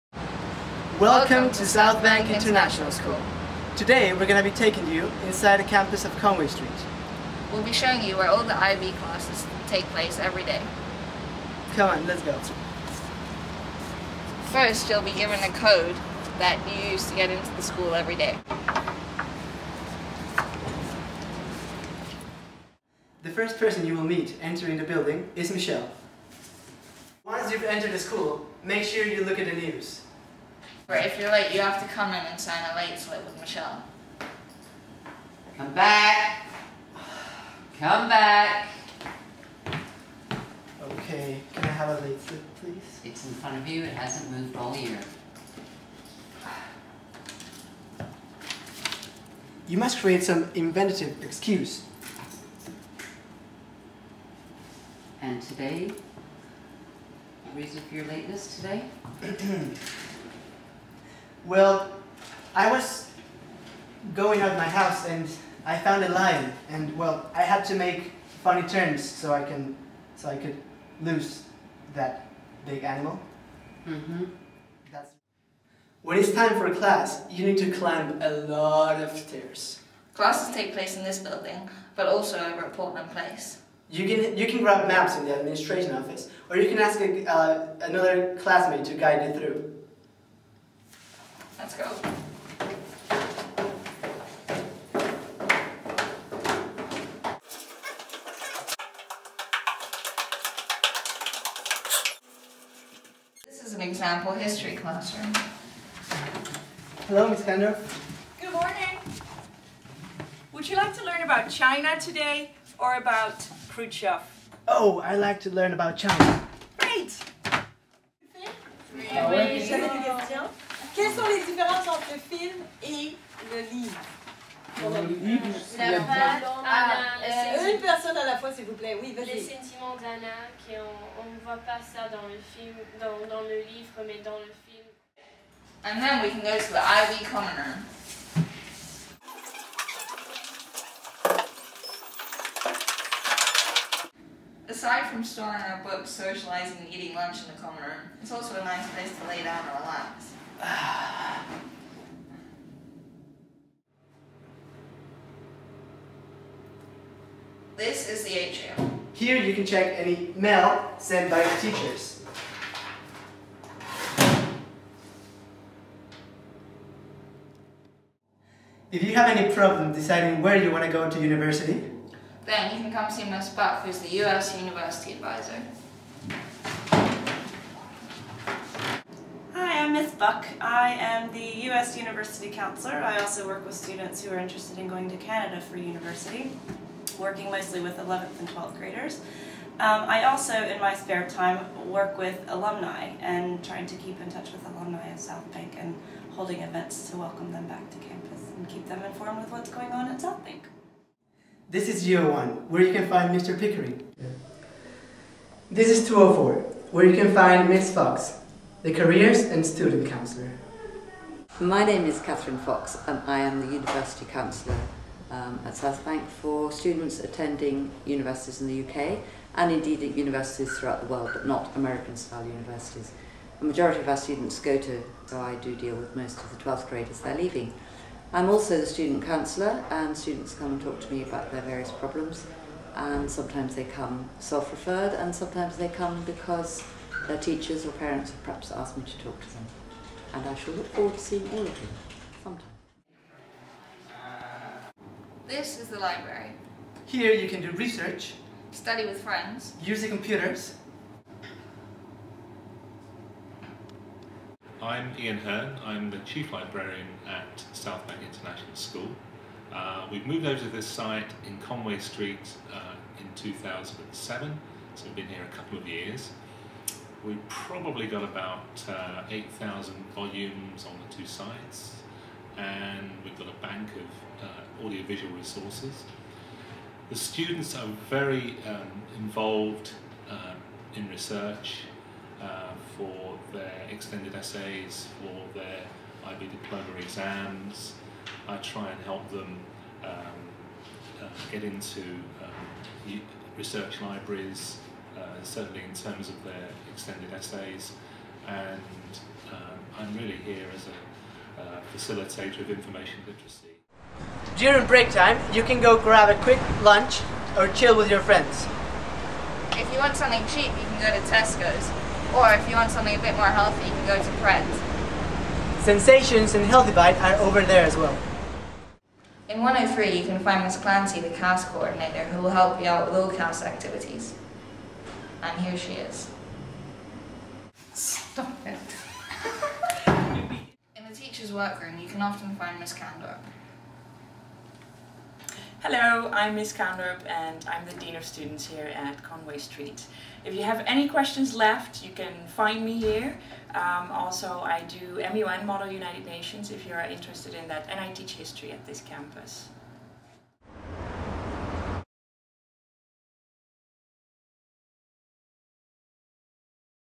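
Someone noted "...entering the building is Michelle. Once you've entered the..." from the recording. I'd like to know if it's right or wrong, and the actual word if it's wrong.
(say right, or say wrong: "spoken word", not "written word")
right.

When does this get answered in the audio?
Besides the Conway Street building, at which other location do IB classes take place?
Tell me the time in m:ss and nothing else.
1:22.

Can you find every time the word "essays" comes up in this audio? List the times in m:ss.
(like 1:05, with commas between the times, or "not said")
4:44, 4:57.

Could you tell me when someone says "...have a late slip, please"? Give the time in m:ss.
0:41.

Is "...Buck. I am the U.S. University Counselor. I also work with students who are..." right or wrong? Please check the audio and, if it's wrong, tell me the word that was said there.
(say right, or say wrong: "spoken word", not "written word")
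right.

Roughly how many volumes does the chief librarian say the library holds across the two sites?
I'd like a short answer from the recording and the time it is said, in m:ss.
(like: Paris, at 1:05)
8,000, at 4:29.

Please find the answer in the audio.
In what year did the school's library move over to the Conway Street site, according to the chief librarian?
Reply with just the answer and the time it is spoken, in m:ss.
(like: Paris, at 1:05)
2007, at 4:23.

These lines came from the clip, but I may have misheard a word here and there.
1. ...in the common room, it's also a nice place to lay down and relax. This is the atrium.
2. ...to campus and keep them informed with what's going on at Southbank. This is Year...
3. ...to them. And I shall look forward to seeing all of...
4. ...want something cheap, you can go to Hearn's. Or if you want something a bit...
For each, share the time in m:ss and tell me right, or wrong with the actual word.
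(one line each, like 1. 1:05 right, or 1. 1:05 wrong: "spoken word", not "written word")
1. 2:27 right
2. 3:17 right
3. 3:59 right
4. 5:09 wrong: "Tesco", not "Hearn".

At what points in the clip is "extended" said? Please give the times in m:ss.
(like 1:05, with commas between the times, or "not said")
4:43, 4:56.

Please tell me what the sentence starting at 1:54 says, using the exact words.
Oh, I like to learn about China.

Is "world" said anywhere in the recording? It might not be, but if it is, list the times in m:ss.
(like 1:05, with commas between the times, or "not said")
3:41.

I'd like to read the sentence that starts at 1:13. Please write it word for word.
hmm That's when it's time for class, you need to climb a lot of stairs.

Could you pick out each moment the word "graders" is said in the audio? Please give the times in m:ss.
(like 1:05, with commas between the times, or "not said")
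3:08, 3:46.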